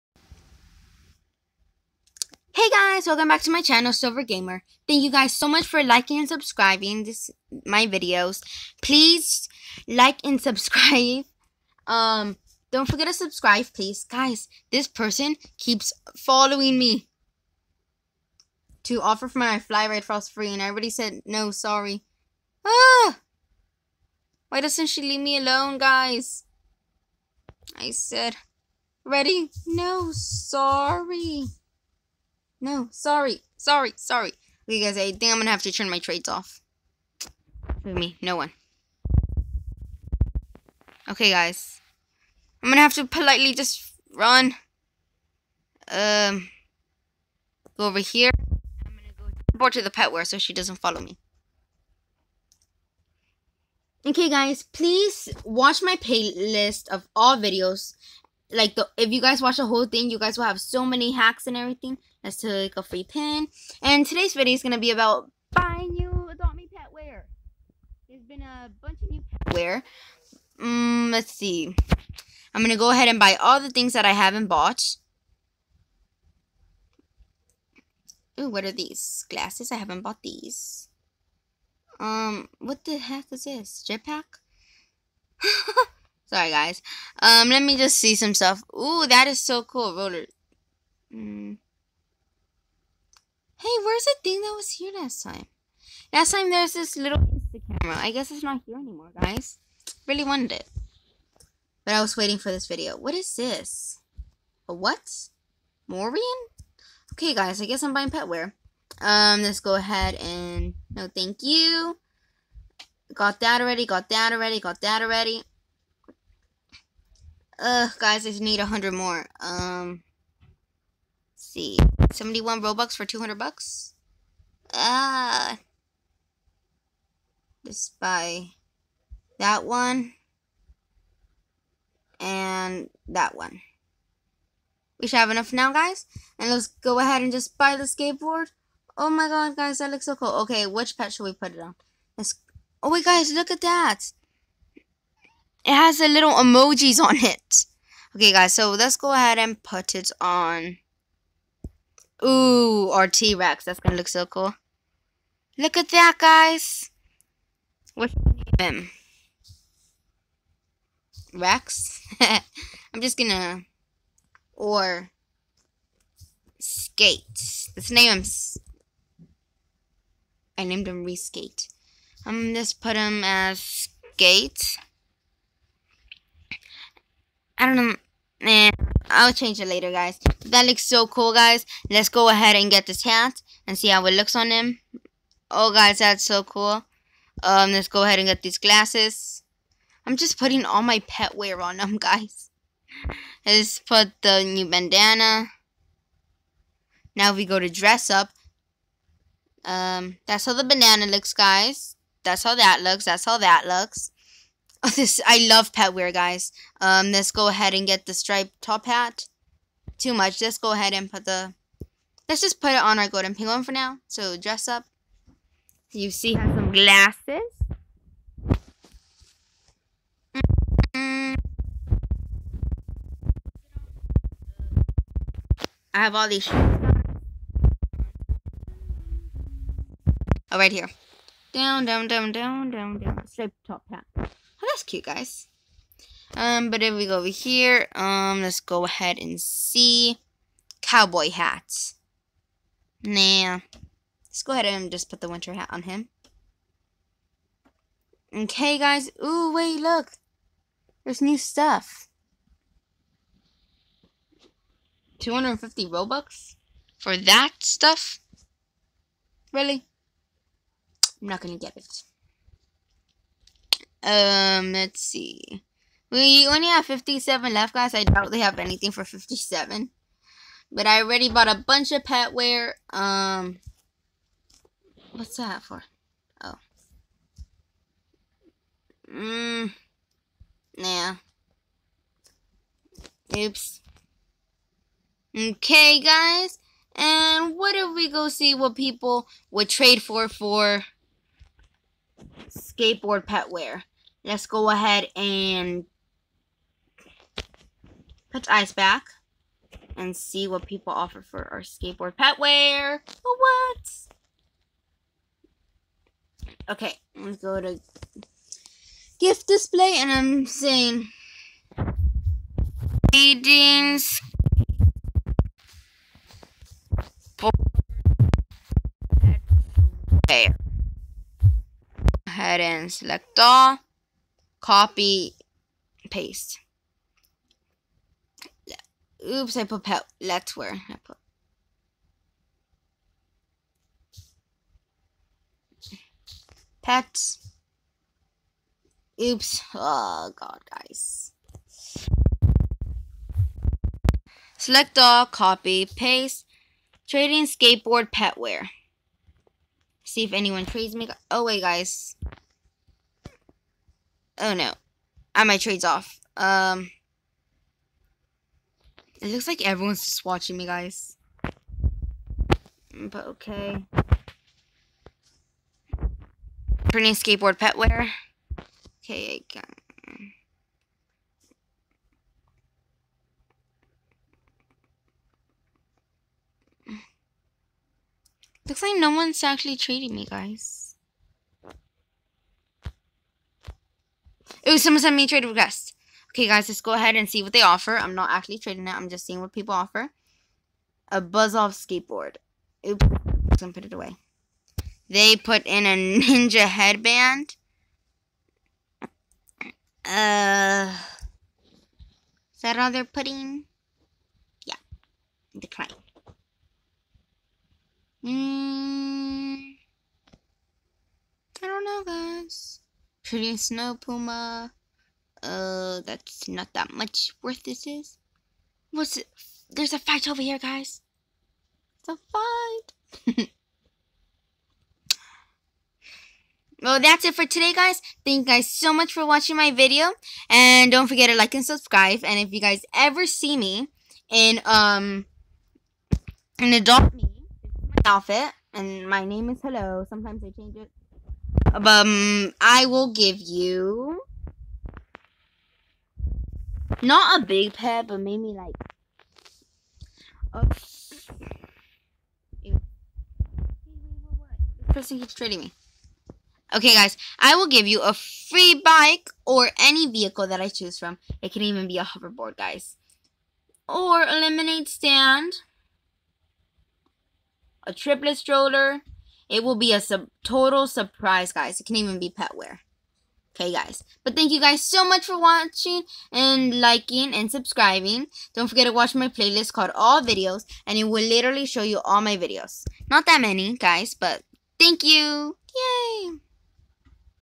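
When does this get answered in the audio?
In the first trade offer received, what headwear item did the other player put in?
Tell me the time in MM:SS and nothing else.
06:36.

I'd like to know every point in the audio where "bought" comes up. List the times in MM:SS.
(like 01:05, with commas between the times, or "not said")
01:14, 01:20, 04:31.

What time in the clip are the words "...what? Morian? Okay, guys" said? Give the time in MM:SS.
01:44.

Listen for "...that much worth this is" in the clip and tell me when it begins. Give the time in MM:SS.
06:56.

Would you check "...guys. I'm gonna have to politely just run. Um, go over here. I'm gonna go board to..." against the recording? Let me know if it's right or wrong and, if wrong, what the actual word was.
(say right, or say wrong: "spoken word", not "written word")
right.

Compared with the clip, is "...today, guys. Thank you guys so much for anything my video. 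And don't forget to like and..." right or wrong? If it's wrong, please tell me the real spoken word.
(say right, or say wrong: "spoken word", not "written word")
wrong: "watching", not "anything".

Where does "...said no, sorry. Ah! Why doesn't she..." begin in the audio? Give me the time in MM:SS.
00:20.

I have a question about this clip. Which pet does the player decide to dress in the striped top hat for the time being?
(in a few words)
Golden penguin.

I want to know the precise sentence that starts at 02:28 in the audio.
Okay, guys, so let's go ahead and put it on.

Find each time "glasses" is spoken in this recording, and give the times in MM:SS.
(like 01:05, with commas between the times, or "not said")
01:19, 03:08, 03:36.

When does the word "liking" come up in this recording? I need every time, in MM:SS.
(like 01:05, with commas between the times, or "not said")
00:05, 07:56.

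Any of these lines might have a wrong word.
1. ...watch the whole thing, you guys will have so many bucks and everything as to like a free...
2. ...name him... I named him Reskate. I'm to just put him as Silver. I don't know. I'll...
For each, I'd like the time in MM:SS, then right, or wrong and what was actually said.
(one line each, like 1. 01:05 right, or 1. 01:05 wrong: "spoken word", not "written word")
1. 00:59 wrong: "hacks", not "bucks"
2. 02:47 wrong: "Skate", not "Silver".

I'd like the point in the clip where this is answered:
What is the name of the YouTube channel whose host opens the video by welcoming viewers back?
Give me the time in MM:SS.
00:03.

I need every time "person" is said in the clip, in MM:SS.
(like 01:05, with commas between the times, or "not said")
00:14, 07:34.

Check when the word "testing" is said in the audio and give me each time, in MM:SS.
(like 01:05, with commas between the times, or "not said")
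not said.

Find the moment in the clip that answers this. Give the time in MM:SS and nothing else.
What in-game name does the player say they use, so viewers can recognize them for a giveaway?
07:19.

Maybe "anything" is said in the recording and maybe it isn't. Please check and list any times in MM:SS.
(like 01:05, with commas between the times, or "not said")
04:28.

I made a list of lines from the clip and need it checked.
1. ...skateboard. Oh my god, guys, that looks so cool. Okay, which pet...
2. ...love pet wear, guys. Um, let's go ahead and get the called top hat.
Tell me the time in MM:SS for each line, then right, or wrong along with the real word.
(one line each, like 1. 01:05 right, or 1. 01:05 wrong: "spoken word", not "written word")
1. 02:17 right
2. 03:25 wrong: "striped", not "called".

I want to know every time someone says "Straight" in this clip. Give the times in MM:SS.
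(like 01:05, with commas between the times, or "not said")
03:53.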